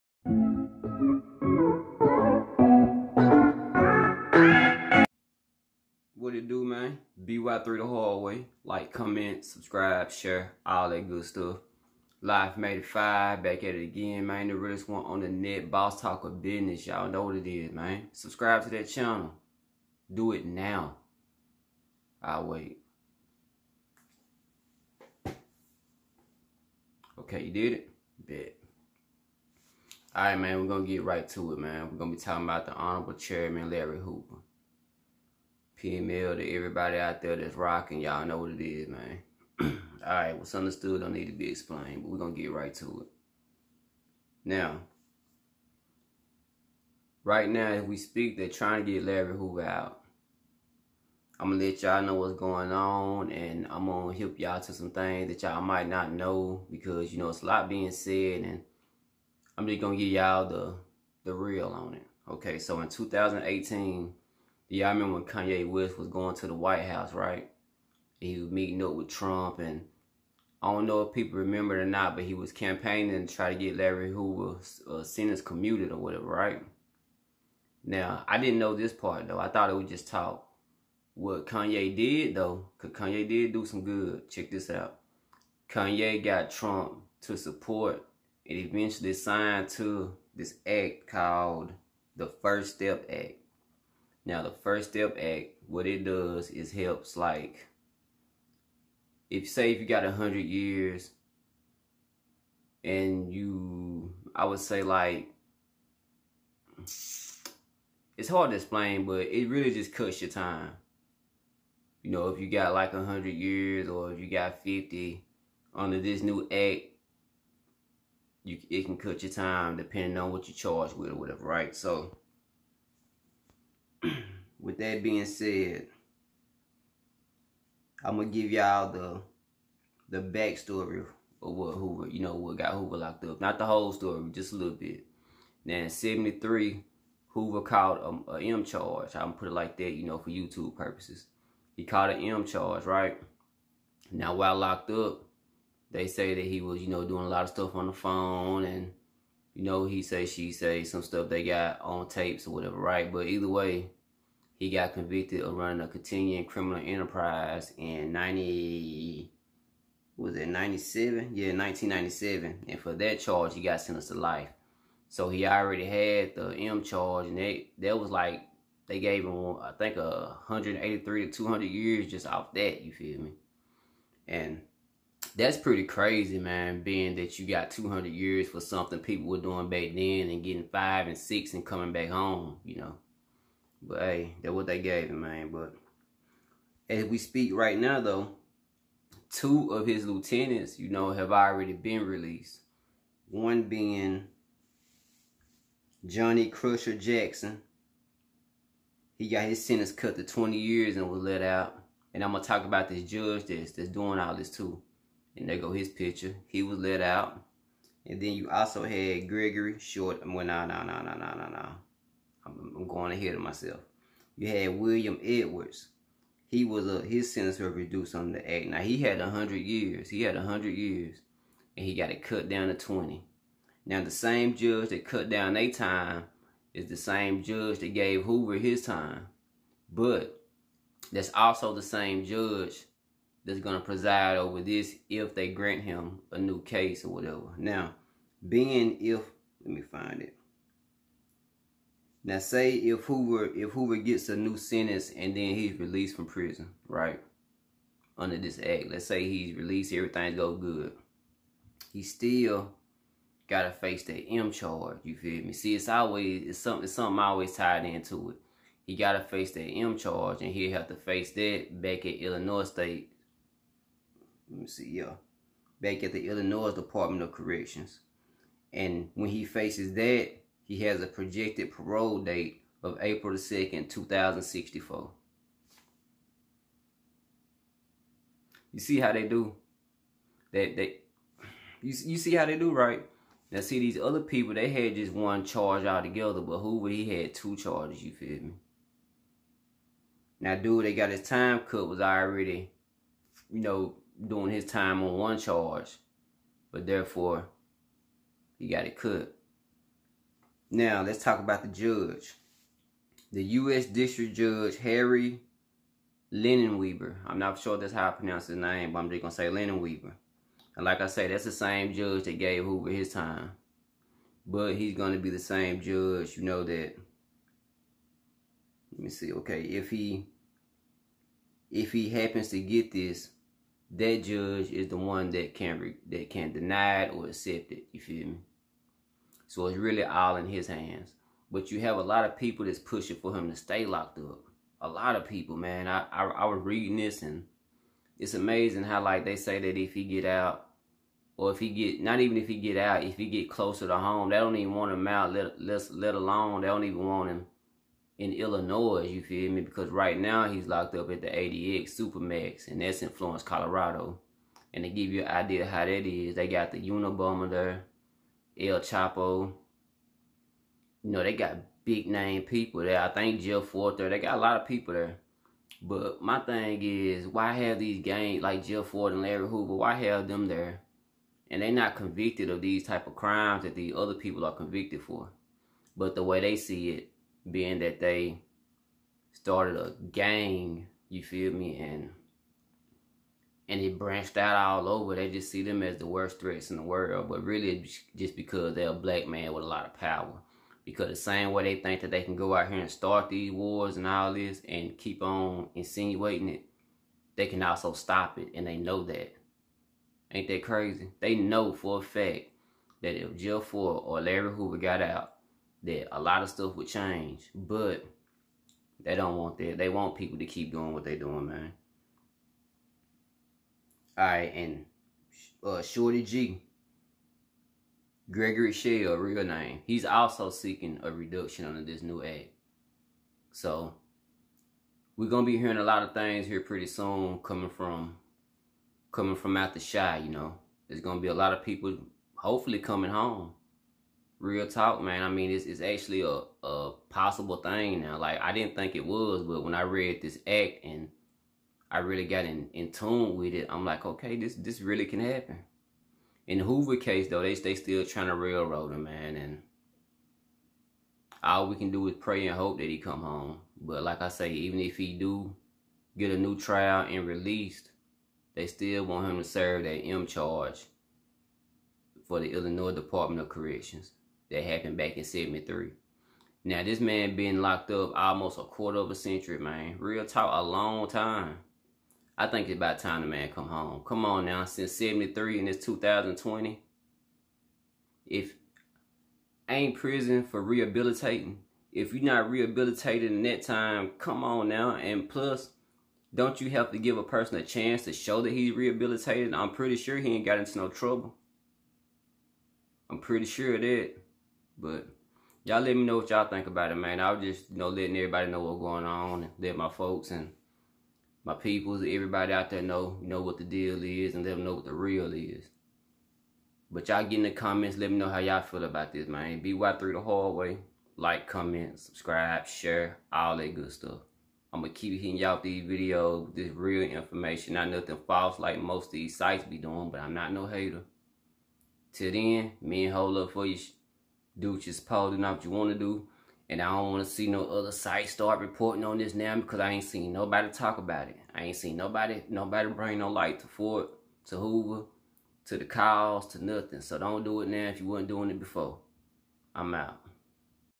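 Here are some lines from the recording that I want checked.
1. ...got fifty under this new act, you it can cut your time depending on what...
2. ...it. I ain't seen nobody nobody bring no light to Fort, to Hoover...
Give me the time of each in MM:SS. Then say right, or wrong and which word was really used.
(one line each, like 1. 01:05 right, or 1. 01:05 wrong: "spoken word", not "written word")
1. 01:54 right
2. 08:51 right.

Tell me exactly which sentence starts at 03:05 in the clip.
But as we speak right now, though, two of his lieutenants, you know, have already been released.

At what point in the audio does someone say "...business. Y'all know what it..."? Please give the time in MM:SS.
00:16.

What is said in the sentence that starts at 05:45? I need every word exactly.
Let let let alone they don't even want him in Illinois, you feel me?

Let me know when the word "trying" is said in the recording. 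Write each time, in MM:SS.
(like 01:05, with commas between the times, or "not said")
00:48, 07:28.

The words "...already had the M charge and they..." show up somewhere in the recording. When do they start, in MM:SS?
02:45.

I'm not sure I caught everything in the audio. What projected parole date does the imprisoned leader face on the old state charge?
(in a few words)
April 2, 2064.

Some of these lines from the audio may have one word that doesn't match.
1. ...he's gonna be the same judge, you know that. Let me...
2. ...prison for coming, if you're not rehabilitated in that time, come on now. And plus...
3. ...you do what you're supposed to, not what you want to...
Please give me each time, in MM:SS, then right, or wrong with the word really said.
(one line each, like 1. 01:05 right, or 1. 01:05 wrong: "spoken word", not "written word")
1. 05:14 right
2. 07:59 wrong: "rehabilitating", not "coming"
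3. 08:43 right.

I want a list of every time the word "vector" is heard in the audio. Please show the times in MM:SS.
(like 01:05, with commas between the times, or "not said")
not said.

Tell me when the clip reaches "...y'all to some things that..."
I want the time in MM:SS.
00:54.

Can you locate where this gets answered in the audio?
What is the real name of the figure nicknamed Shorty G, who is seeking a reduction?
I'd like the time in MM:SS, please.
06:58.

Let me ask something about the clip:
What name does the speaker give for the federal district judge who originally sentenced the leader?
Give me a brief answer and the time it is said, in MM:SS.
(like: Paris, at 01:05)
Harry Weaver, at 05:04.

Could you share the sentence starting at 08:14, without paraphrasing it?
But y'all let me know what y'all think about it, man.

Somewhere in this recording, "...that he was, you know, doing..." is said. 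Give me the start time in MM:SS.
02:26.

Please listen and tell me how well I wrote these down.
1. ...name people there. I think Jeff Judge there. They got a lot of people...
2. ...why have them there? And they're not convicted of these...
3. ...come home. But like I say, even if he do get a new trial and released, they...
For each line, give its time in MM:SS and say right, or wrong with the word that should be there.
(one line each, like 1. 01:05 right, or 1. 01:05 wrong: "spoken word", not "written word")
1. 06:02 wrong: "Fort", not "Judge"
2. 06:09 right
3. 07:32 right.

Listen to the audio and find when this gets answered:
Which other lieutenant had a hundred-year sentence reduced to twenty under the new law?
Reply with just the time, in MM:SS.
03:34.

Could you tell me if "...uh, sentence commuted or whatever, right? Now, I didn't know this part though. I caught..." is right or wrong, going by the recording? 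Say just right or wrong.
wrong.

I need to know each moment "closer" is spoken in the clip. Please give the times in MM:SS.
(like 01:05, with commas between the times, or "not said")
05:43.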